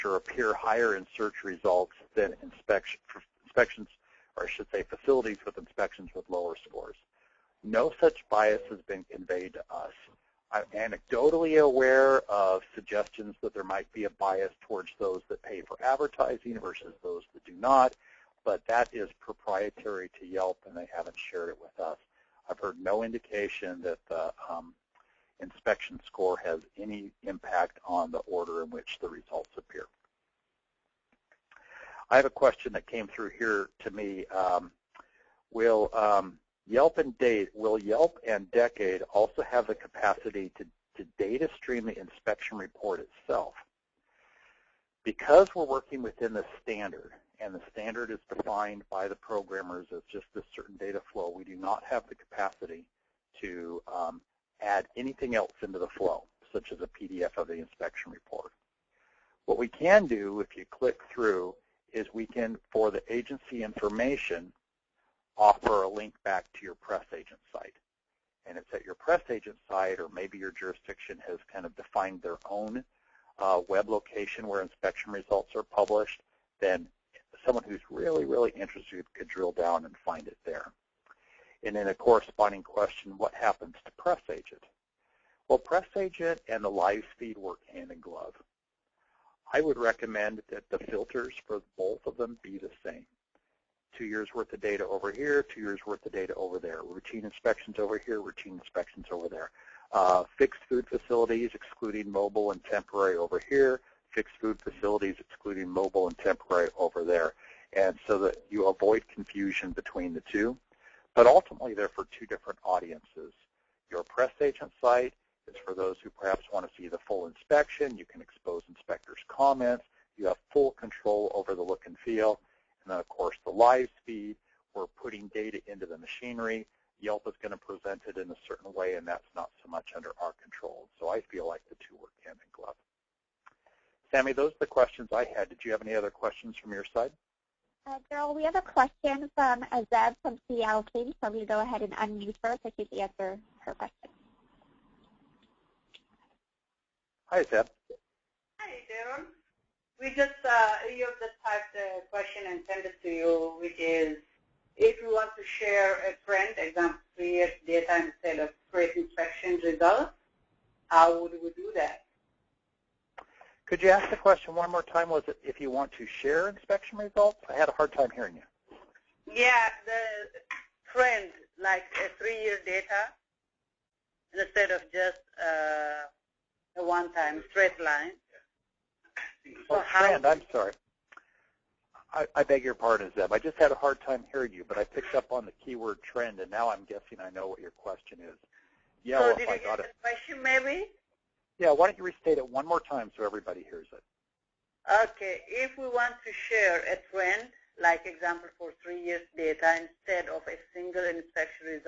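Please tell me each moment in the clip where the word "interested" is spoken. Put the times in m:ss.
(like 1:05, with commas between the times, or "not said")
1:18.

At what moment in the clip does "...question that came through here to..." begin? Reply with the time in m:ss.
0:32.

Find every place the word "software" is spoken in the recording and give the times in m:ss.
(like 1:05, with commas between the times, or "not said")
not said.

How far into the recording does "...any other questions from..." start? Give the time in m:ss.
2:15.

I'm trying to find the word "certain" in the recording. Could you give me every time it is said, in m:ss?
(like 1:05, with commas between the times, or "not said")
0:50, 2:08.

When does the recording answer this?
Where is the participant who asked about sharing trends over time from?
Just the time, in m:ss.
2:20.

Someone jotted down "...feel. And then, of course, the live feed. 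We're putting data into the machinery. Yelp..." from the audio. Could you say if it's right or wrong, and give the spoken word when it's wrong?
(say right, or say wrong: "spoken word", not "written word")
right.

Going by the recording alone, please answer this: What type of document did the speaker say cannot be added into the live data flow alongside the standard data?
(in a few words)
PDF of the inspection report.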